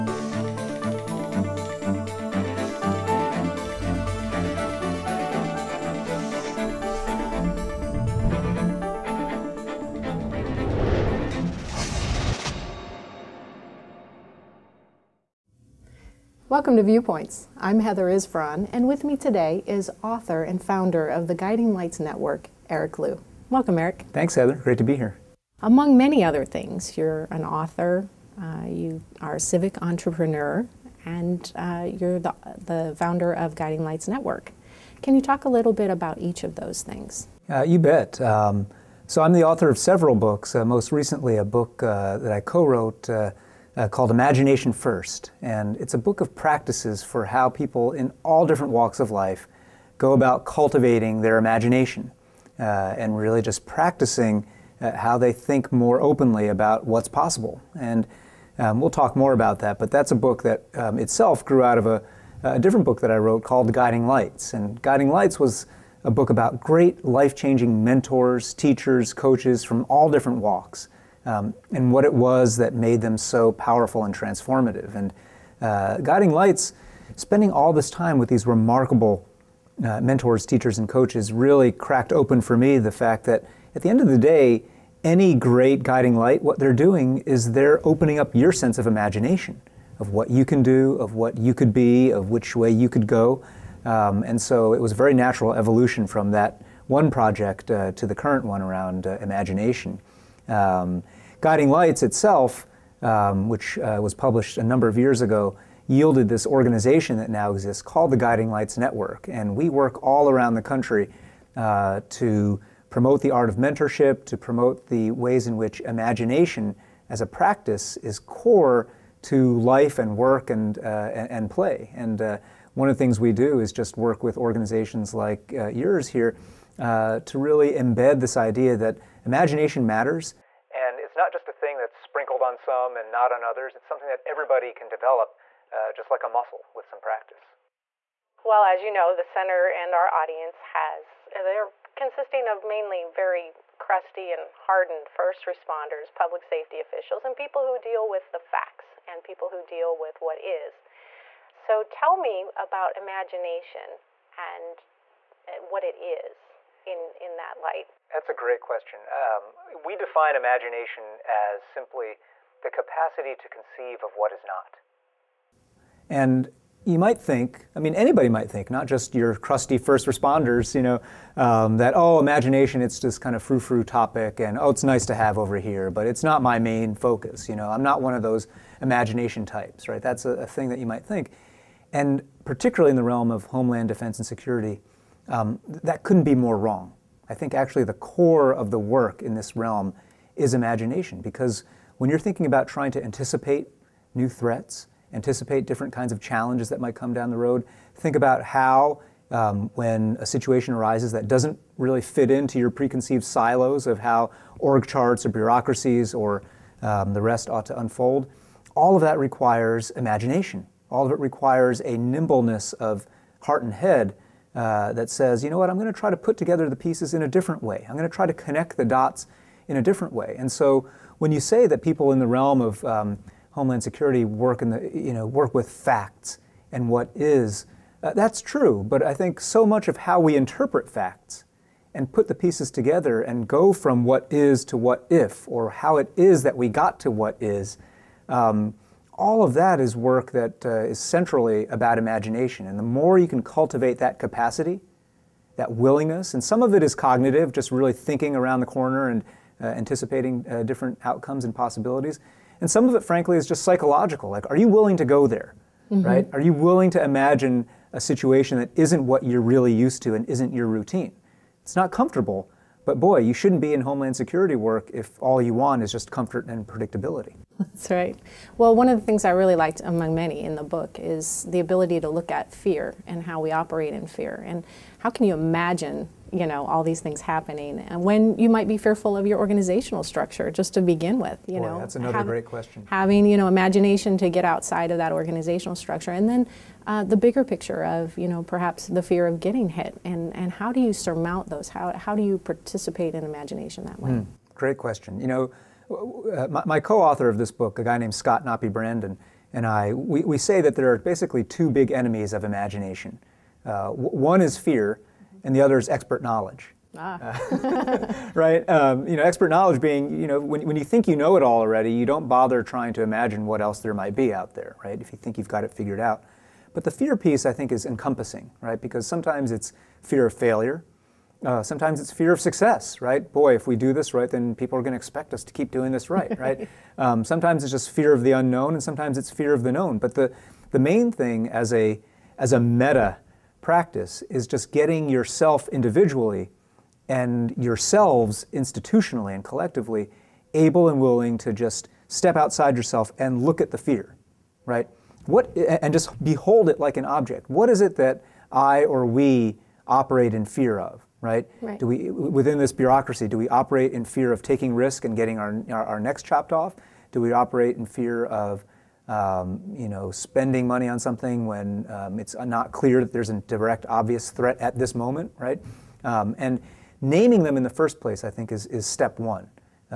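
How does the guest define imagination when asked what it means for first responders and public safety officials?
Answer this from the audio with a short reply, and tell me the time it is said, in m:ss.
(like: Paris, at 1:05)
The capacity to conceive of what is not, at 2:42.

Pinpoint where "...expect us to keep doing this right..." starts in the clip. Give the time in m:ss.
5:24.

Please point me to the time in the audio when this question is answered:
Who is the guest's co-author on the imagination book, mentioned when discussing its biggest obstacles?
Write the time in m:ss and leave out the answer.
4:58.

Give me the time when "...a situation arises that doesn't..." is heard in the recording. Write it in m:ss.
3:20.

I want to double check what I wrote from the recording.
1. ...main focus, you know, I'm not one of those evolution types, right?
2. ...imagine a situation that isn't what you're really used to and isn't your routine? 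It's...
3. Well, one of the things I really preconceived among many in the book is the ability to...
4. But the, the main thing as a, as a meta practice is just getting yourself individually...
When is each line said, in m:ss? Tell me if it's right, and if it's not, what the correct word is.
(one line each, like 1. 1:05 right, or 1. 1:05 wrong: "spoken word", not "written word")
1. 2:56 wrong: "imagination", not "evolution"
2. 4:17 right
3. 4:28 wrong: "liked", not "preconceived"
4. 5:29 right.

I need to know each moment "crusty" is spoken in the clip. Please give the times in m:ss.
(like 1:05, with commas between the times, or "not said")
2:23, 2:49.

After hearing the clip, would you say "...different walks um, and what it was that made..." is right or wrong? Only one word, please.
right.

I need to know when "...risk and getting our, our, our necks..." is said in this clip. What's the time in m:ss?
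5:54.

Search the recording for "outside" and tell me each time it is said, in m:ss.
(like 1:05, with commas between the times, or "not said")
4:44, 5:42.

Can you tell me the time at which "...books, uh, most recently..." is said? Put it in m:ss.
0:40.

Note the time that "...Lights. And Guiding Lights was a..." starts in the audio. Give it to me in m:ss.
1:04.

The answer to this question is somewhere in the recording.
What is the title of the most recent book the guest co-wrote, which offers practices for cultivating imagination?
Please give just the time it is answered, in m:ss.
0:44.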